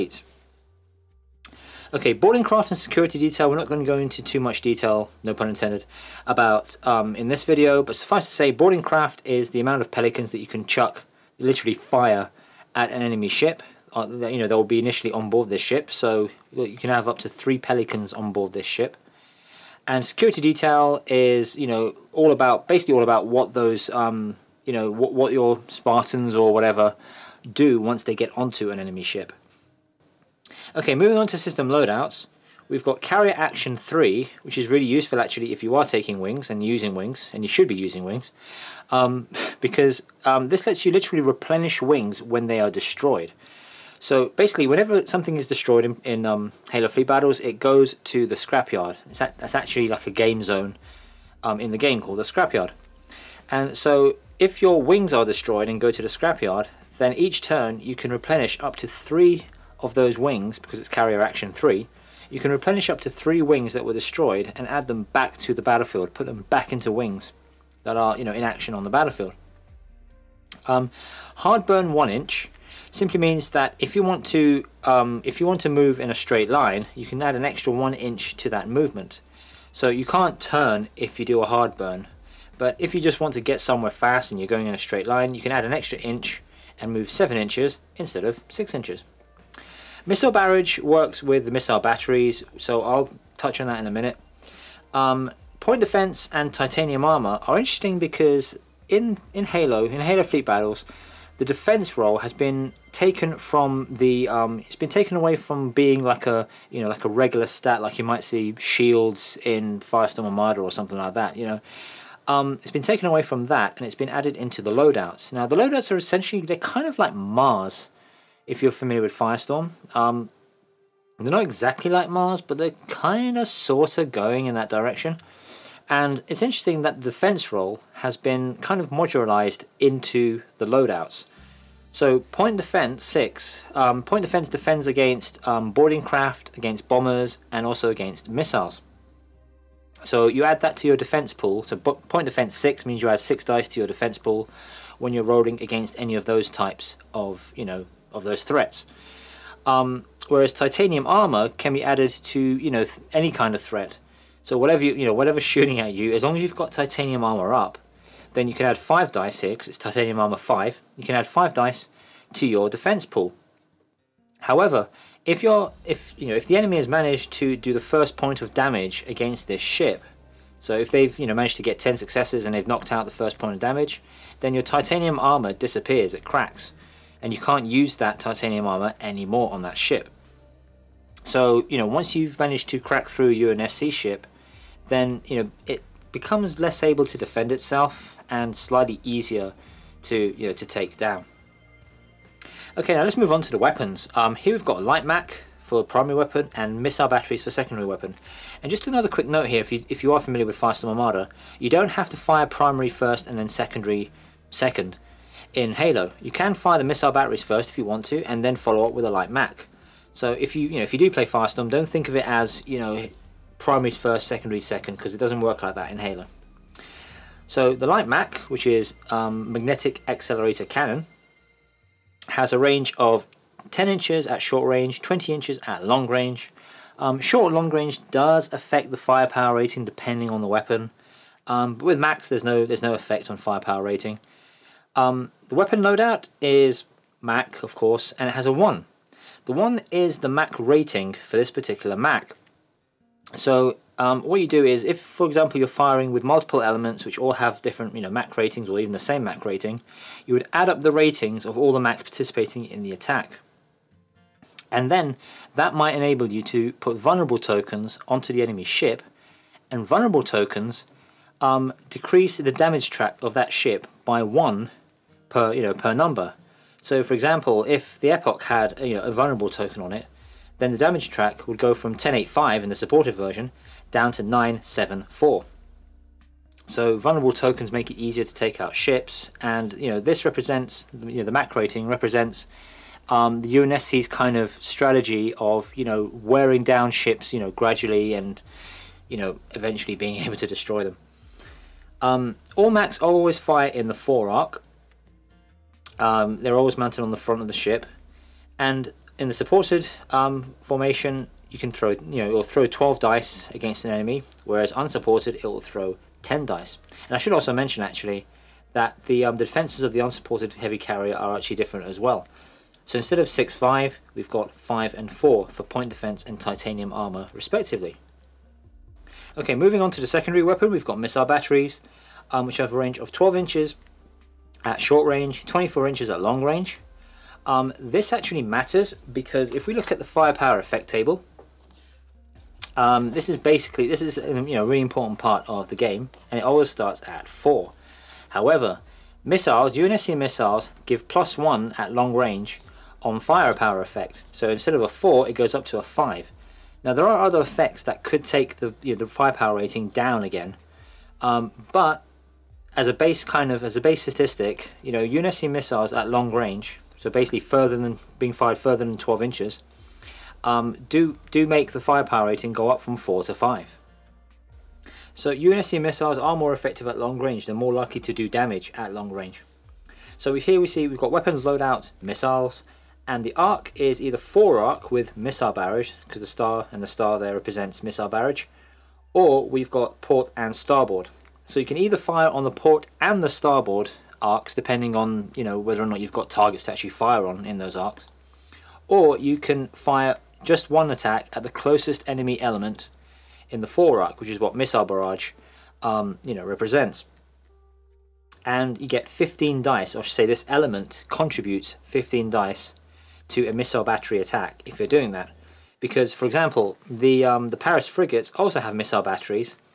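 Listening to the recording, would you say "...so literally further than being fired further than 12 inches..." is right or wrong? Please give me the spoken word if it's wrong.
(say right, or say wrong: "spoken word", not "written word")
wrong: "basically", not "literally".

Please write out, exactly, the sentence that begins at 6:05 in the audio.
So UNSC missiles are more effective at long range.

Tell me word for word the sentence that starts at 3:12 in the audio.
Okay, now let's move on to the weapons.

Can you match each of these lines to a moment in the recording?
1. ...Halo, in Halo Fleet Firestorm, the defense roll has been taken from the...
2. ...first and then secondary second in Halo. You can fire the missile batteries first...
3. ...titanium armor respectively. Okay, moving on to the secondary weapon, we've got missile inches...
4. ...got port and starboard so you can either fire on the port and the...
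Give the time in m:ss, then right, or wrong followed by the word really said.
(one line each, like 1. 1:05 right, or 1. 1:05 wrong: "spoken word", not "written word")
1. 1:39 wrong: "Battles", not "Firestorm"
2. 3:22 right
3. 5:16 wrong: "batteries", not "inches"
4. 6:19 right.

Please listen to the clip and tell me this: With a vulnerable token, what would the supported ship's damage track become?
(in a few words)
974.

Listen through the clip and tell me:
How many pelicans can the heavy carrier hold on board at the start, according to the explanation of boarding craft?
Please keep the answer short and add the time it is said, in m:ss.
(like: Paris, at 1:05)
3, at 0:17.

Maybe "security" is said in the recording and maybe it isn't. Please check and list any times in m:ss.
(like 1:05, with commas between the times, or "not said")
0:02, 0:20.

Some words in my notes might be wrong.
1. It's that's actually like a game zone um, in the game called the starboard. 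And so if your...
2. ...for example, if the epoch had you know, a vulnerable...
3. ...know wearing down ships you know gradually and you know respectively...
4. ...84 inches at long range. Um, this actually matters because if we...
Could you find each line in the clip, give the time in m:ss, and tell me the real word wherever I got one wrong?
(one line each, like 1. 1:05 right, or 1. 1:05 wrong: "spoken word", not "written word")
1. 0:49 wrong: "scrapyard", not "starboard"
2. 4:27 right
3. 4:45 wrong: "eventually", not "respectively"
4. 5:25 wrong: "24", not "84".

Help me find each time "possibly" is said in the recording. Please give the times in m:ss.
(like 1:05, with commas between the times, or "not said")
not said.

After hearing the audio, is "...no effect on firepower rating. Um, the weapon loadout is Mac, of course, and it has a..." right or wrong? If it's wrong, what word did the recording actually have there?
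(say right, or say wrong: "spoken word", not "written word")
right.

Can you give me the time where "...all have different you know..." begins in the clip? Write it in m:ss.
4:07.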